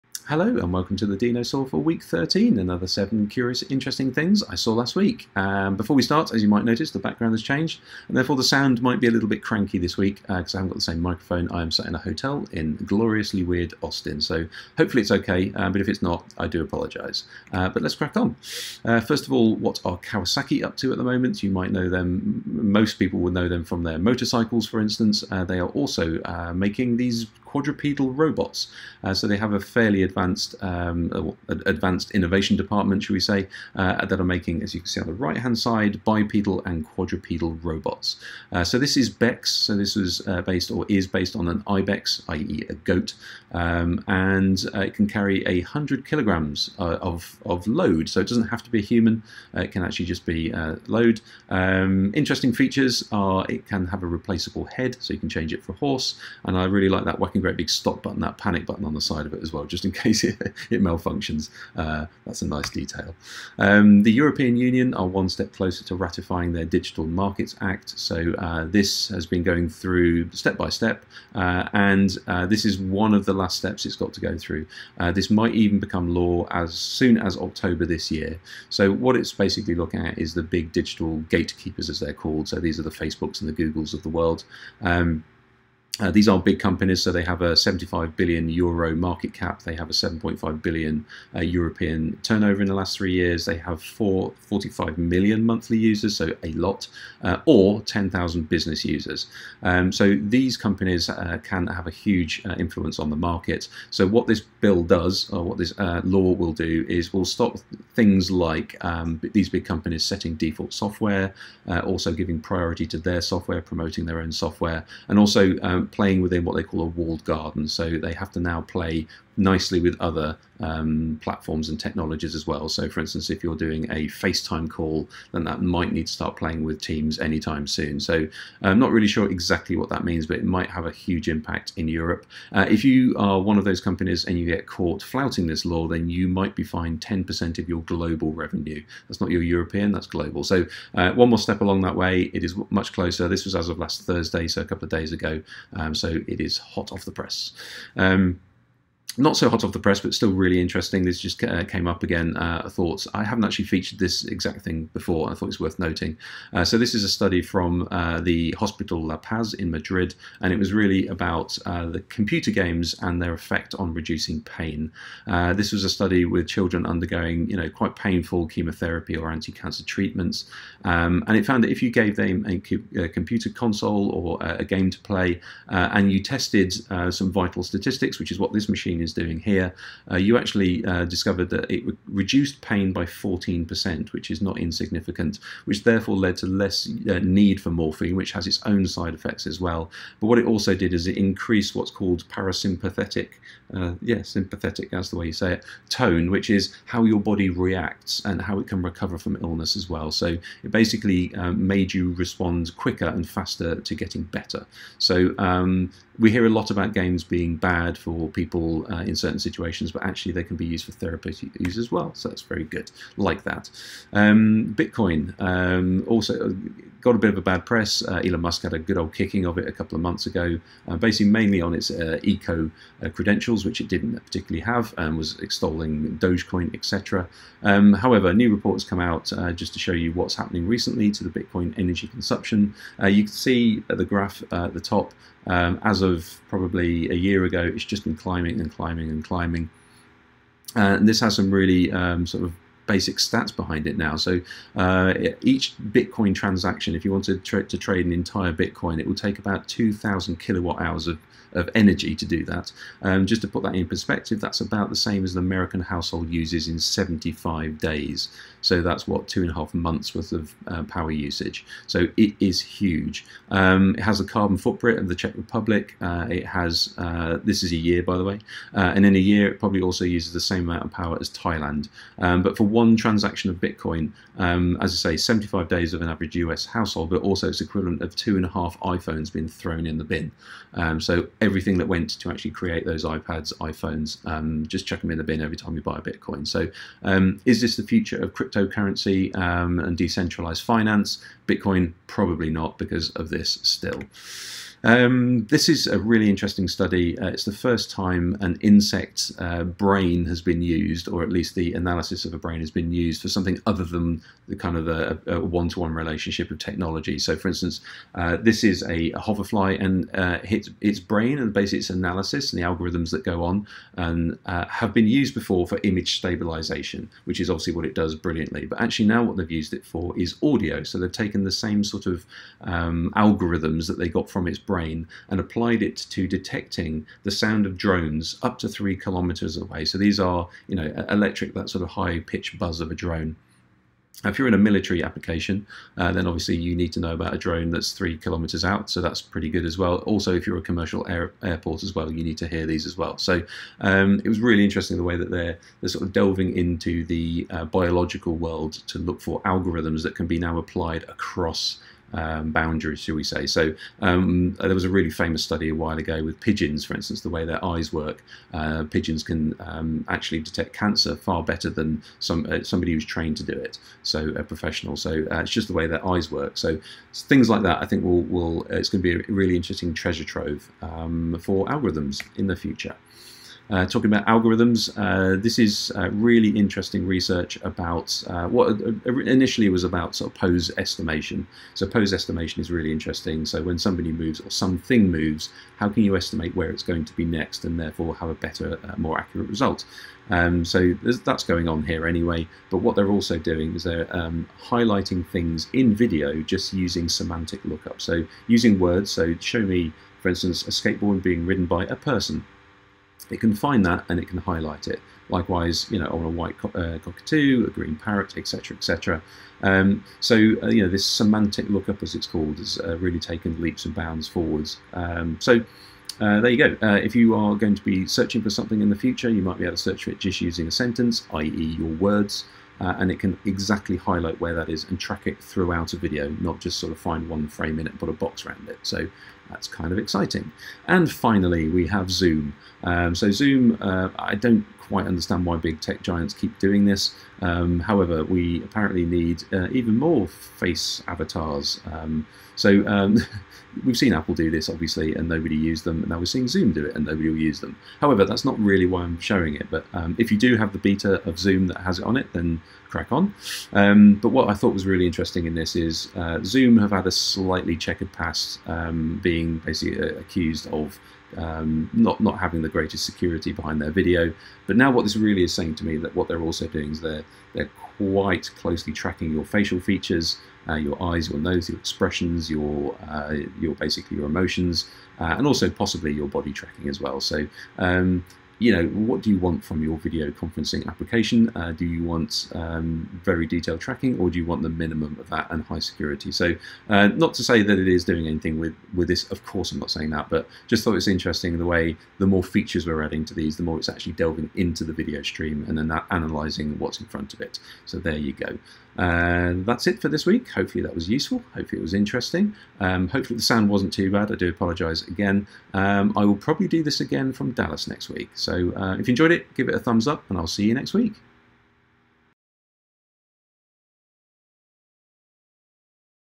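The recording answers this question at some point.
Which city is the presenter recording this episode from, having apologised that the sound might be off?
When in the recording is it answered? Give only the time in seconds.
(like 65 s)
13 s.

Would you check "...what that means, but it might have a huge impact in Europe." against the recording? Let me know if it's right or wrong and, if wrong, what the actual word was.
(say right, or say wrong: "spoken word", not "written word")
right.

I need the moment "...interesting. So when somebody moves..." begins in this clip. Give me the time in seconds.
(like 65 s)
382 s.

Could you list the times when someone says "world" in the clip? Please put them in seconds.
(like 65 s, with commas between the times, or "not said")
84 s, 348 s.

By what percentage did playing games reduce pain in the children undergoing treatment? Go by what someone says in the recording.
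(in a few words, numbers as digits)
14%.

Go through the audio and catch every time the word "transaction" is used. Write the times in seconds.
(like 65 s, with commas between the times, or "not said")
246 s, 272 s.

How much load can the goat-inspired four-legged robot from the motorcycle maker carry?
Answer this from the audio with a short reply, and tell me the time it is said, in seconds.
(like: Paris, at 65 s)
100 kilograms, at 45 s.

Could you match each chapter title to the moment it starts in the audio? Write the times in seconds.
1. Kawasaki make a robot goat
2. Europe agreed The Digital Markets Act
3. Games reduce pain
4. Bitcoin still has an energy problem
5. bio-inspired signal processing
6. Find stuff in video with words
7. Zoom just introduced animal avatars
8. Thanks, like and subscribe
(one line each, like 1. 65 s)
1. 17 s
2. 62 s
3. 152 s
4. 211 s
5. 294 s
6. 372 s
7. 429 s
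8. 499 s.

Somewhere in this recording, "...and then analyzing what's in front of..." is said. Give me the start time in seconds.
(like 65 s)
495 s.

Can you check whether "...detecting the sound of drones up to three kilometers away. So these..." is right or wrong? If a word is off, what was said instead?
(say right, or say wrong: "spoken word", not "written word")
right.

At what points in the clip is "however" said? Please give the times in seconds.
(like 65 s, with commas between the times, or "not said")
227 s, 437 s, 447 s.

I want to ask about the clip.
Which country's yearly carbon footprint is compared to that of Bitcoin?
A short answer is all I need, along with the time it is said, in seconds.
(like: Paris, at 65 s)
Czech Republic, at 265 s.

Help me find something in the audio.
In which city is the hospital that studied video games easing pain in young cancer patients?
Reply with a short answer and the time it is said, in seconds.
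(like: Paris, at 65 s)
Madrid, at 159 s.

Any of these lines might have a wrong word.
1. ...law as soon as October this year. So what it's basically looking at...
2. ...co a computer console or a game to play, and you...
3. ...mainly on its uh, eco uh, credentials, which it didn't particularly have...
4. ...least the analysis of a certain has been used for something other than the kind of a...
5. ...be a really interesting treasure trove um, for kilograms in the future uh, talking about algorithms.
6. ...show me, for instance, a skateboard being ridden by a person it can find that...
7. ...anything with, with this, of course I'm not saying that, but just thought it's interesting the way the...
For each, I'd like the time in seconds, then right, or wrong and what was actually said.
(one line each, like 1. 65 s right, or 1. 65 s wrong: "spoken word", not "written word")
1. 76 s right
2. 172 s right
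3. 221 s right
4. 301 s wrong: "brain", not "certain"
5. 369 s wrong: "algorithms", not "kilograms"
6. 399 s right
7. 488 s right.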